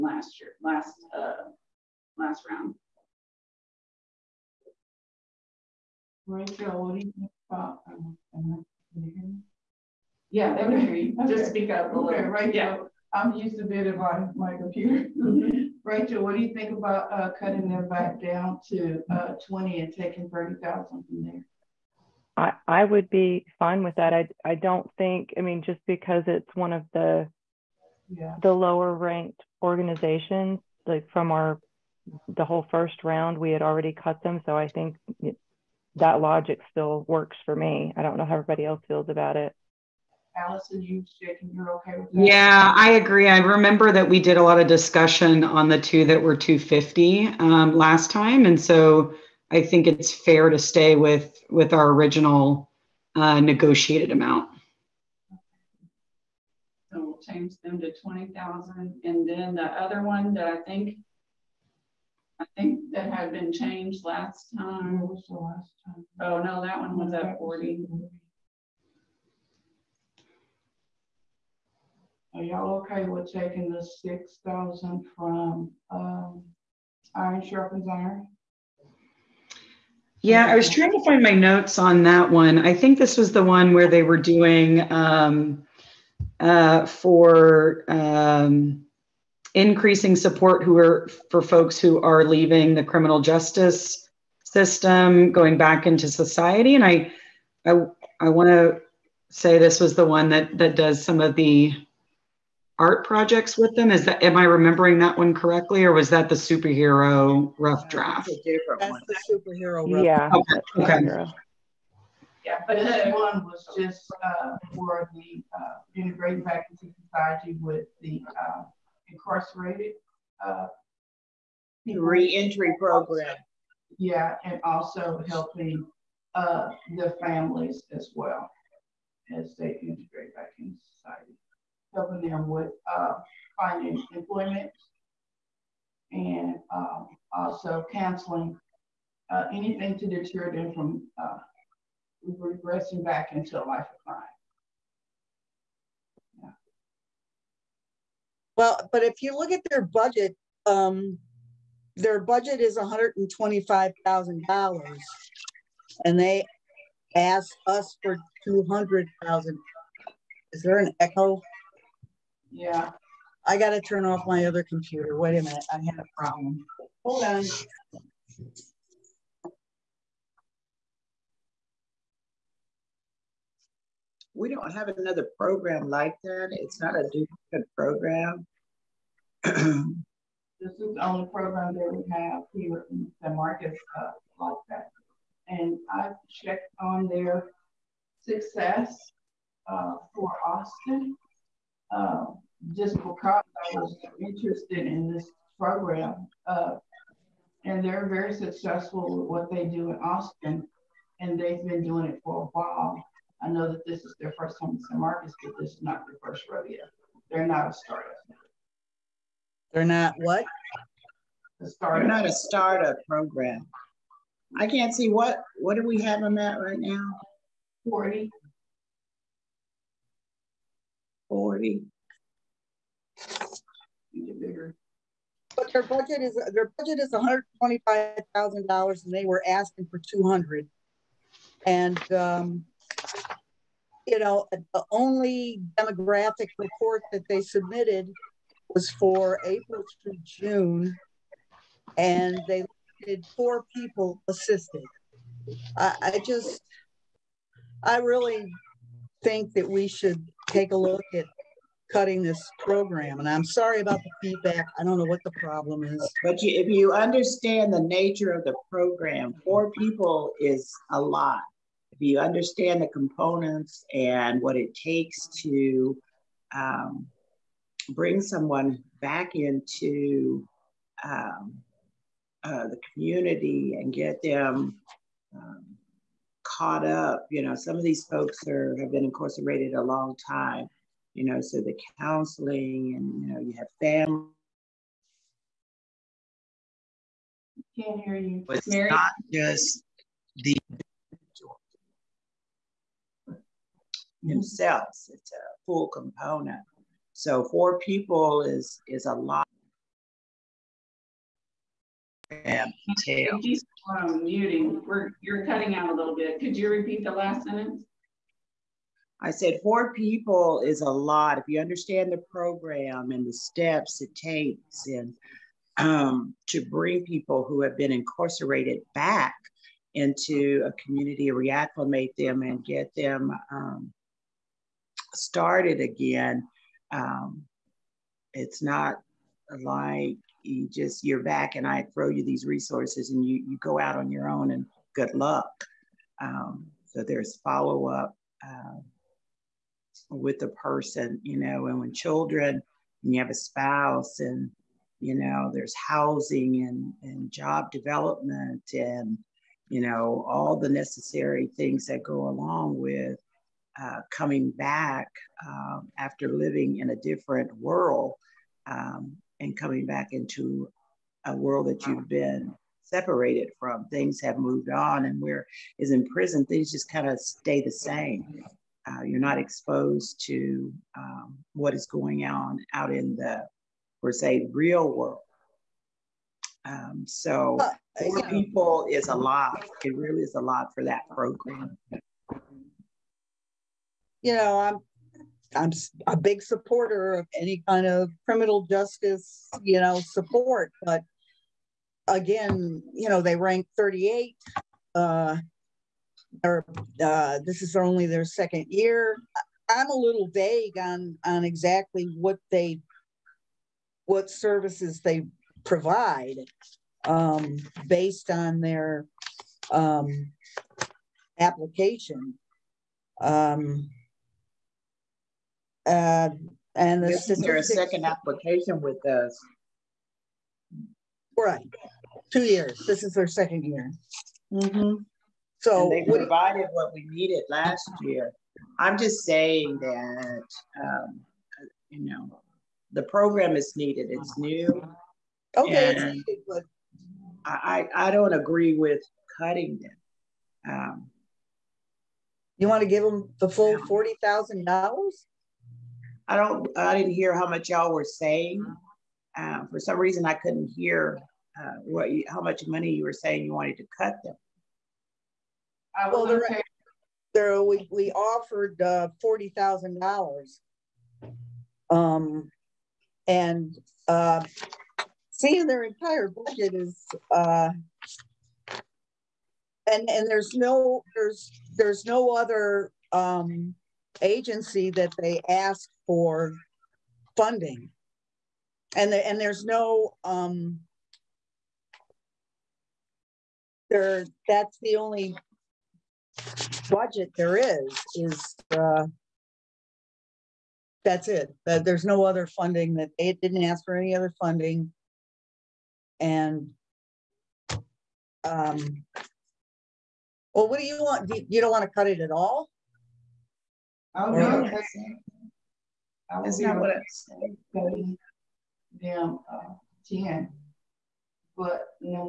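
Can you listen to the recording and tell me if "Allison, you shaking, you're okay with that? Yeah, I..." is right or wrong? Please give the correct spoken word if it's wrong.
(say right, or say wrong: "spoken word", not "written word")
right.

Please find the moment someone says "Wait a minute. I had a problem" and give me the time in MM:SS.
02:45.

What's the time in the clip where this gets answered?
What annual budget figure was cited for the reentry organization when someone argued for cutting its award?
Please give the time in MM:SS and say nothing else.
02:32.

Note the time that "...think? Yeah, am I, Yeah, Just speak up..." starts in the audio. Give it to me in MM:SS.
00:07.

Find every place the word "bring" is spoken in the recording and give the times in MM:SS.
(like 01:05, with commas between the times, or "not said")
04:27, 05:16.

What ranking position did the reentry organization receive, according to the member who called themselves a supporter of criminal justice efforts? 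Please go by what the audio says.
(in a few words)
38.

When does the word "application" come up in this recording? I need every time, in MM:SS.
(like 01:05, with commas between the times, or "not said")
06:51, 06:58.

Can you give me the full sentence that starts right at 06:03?
Things have moved on, and where is in prison, things just kind of stay the same.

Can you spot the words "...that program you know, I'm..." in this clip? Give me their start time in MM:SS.
06:20.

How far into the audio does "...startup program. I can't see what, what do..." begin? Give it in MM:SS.
03:32.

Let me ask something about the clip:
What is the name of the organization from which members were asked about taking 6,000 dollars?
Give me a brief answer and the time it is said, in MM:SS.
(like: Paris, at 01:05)
Iron Sharpens Iron, at 01:17.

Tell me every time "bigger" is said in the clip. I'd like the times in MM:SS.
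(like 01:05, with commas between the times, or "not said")
03:44.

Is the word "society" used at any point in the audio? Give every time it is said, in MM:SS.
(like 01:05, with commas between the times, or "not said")
01:36, 01:56, 02:10.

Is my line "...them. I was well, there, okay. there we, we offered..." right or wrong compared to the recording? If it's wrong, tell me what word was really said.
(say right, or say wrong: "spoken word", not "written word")
right.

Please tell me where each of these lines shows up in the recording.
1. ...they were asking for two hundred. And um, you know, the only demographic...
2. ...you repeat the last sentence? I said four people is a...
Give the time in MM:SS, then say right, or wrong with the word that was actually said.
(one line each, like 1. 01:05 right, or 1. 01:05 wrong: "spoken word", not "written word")
1. 03:49 right
2. 05:06 right.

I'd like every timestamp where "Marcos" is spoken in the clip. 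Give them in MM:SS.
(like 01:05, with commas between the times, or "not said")
03:03, 03:24.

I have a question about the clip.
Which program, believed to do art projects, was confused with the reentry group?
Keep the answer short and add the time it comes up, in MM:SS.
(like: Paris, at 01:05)
superhero rough draft, at 01:46.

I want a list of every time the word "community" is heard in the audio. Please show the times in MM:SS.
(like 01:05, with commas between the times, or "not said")
04:32, 05:20.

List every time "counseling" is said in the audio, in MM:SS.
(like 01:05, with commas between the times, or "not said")
02:17, 04:41.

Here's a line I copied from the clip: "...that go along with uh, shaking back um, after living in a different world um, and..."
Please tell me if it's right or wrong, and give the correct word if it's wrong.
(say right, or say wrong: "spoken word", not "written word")
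wrong: "coming", not "shaking".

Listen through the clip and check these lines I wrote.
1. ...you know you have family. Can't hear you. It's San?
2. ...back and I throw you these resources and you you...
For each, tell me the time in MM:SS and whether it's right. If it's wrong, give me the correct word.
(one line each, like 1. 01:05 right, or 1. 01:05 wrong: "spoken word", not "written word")
1. 04:43 wrong: "Mary", not "San"
2. 05:31 right.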